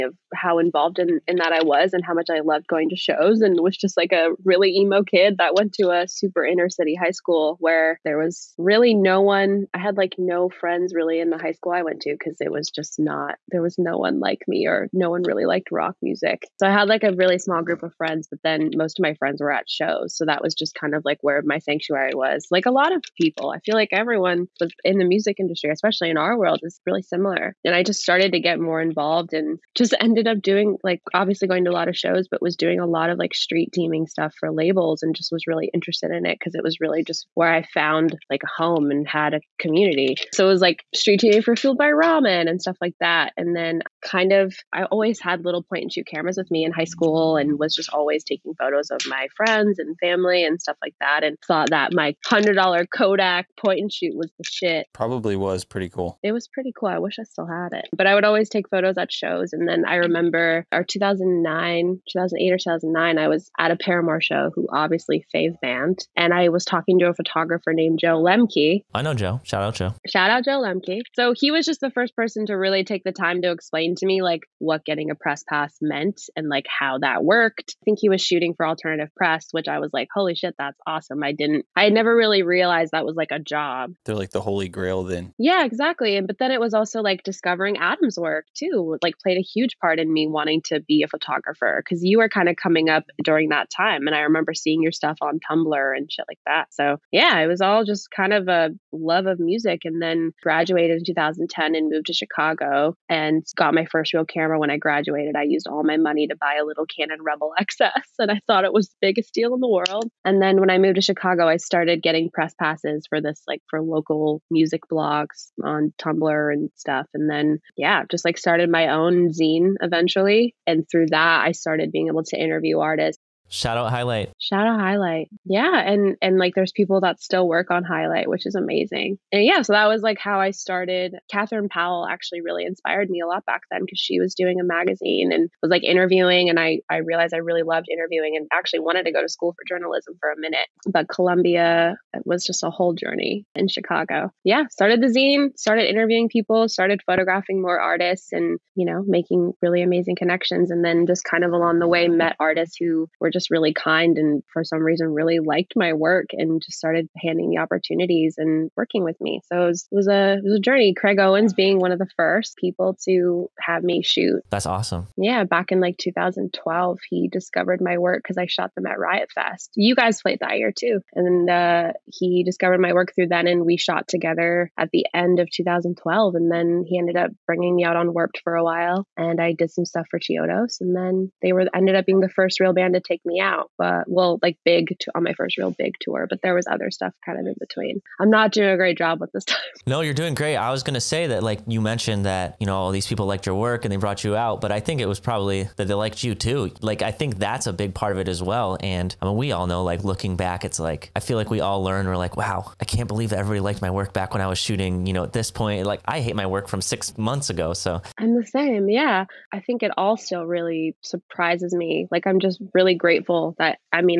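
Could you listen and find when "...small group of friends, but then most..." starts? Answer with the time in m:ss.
0:17.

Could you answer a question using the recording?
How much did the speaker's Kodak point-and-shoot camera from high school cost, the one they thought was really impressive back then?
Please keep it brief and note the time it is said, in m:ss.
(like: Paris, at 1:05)
$100, at 0:52.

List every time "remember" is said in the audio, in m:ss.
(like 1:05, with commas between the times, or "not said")
0:59, 1:34.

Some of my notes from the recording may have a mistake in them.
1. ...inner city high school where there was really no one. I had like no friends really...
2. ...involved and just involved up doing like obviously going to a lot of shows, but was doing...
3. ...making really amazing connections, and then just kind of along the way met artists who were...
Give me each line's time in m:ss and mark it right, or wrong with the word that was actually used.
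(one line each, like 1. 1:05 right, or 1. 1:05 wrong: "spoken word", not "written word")
1. 0:06 right
2. 0:28 wrong: "ended", not "involved"
3. 2:29 right.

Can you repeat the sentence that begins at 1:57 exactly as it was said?
And then, yeah, just like started my own zine eventually.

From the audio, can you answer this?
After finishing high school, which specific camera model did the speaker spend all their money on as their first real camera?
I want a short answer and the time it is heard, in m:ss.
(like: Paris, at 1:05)
Canon Rebel XS, at 1:46.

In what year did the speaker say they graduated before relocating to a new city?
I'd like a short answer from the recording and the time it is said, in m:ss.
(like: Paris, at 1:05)
2010, at 1:41.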